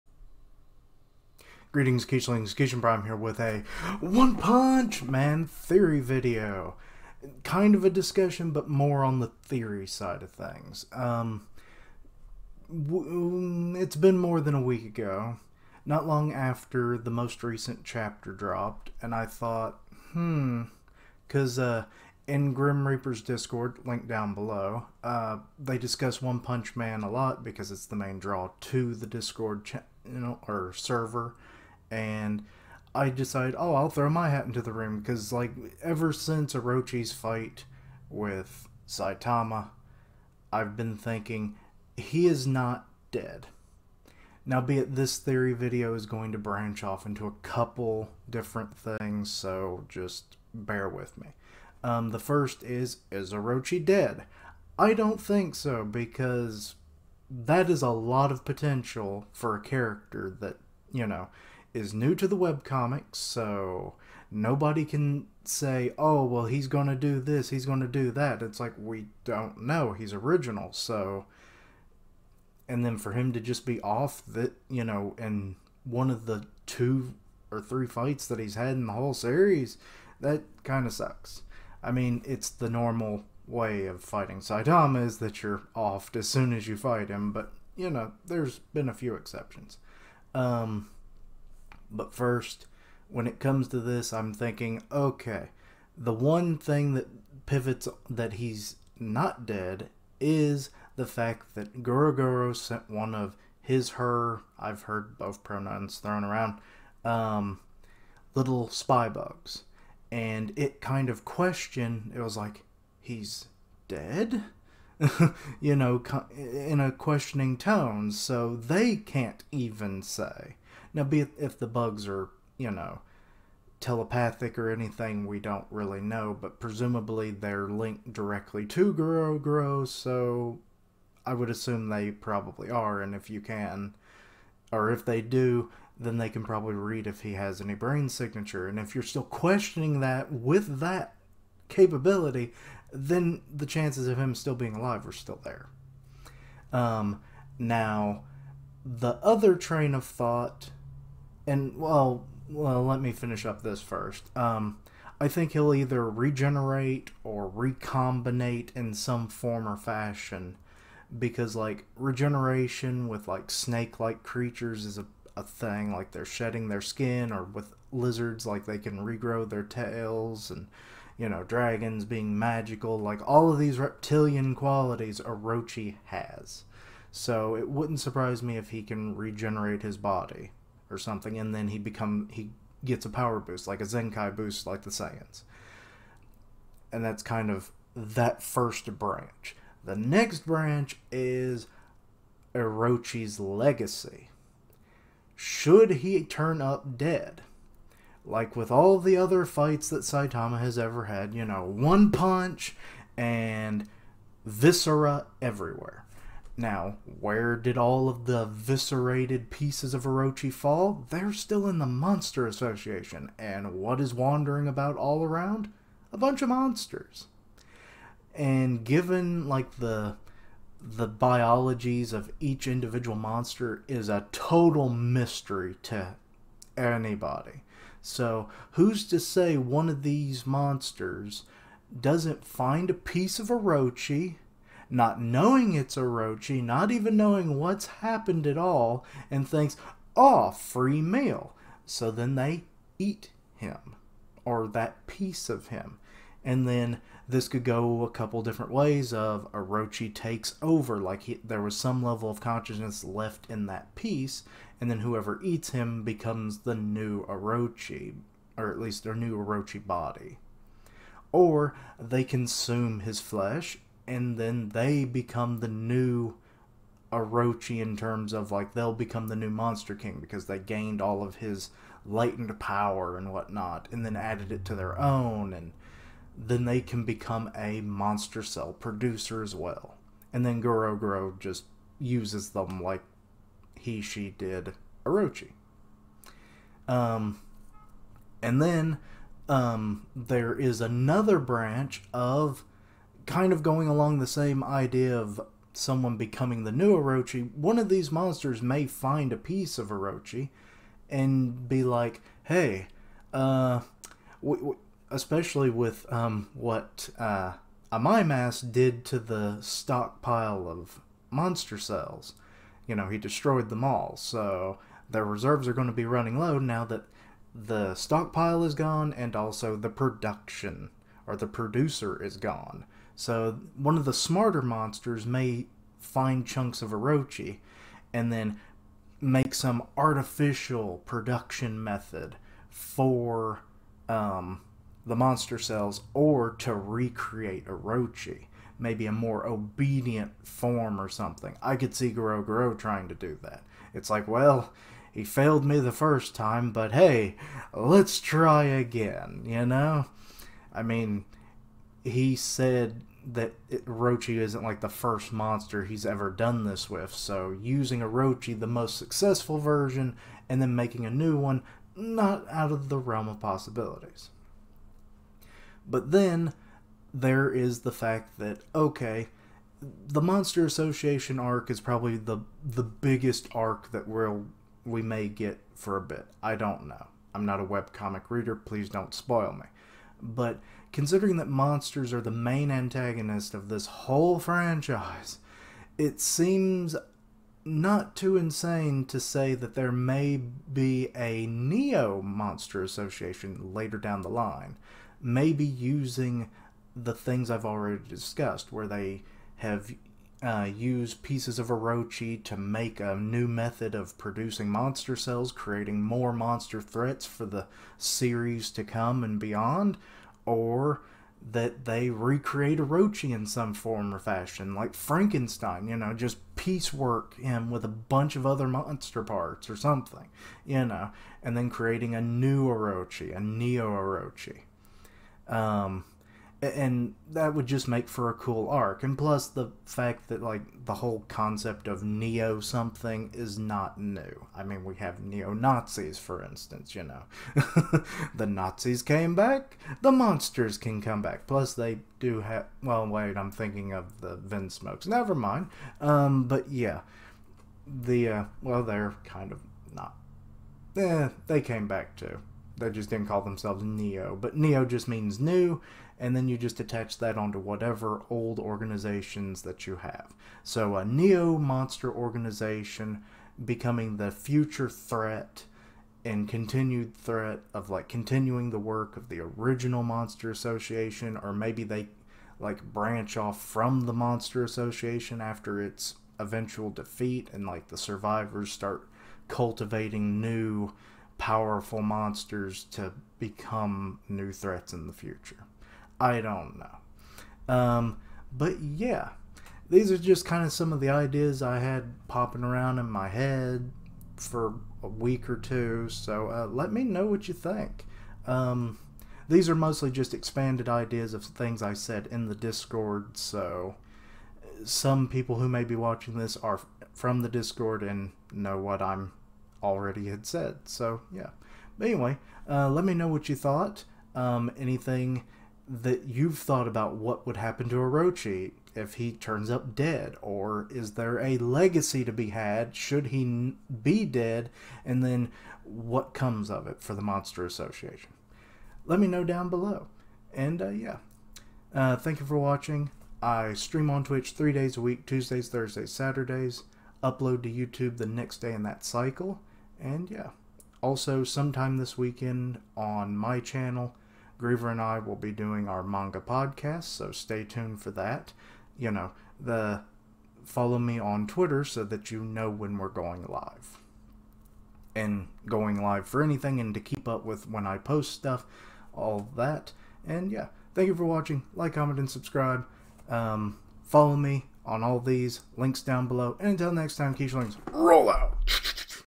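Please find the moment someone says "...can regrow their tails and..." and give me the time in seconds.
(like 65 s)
168 s.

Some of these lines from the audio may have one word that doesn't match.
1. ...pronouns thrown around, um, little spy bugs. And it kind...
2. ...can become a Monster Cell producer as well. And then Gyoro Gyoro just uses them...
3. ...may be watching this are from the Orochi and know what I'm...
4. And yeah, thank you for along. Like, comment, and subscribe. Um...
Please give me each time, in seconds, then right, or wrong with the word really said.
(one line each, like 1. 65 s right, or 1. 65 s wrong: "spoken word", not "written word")
1. 105 s right
2. 276 s right
3. 505 s wrong: "Discord", not "Orochi"
4. 560 s wrong: "watching", not "along".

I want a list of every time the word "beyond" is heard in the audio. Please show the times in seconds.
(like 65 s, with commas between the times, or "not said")
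409 s.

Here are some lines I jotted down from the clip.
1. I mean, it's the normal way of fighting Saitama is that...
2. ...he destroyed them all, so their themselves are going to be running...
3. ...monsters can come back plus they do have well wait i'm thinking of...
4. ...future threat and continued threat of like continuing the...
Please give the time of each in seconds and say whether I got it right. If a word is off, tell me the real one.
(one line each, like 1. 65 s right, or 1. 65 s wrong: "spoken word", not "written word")
1. 81 s right
2. 313 s wrong: "reserves", not "themselves"
3. 440 s right
4. 464 s right.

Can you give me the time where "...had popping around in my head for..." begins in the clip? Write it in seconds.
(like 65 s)
491 s.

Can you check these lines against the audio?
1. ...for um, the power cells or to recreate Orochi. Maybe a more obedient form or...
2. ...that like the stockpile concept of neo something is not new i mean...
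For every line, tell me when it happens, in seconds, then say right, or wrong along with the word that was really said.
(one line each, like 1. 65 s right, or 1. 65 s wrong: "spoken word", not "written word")
1. 332 s wrong: "monster", not "power"
2. 430 s wrong: "whole", not "stockpile".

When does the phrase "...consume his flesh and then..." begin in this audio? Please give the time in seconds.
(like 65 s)
262 s.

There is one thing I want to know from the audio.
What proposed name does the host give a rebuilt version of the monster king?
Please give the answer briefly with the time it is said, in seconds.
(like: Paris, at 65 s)
Neo Orochi, at 423 s.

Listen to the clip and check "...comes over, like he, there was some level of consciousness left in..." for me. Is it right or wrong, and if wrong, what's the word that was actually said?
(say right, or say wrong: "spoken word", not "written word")
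wrong: "takes", not "comes".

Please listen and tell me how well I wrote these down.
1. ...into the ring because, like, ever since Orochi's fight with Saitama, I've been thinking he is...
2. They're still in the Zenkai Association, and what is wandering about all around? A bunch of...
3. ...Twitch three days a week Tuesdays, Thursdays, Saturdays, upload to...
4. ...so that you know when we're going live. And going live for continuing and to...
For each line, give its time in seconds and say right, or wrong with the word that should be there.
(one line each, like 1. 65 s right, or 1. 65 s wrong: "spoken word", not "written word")
1. 34 s right
2. 211 s wrong: "Monster", not "Zenkai"
3. 534 s right
4. 551 s wrong: "anything", not "continuing".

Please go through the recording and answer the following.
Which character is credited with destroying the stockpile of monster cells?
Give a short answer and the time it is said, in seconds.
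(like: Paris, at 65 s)
Mass, at 307 s.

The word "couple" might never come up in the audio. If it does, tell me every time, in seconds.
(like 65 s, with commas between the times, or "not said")
47 s, 248 s.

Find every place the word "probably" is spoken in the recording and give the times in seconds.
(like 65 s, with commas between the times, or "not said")
132 s, 136 s, 371 s.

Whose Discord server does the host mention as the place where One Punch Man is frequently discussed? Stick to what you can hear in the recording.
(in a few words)
Grim Reaper.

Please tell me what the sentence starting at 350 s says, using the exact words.
I mean, he said that it, Orochi isn't like the first monster he's ever done this with.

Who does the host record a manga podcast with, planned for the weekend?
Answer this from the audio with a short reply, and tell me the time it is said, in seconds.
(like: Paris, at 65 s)
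Griever, at 544 s.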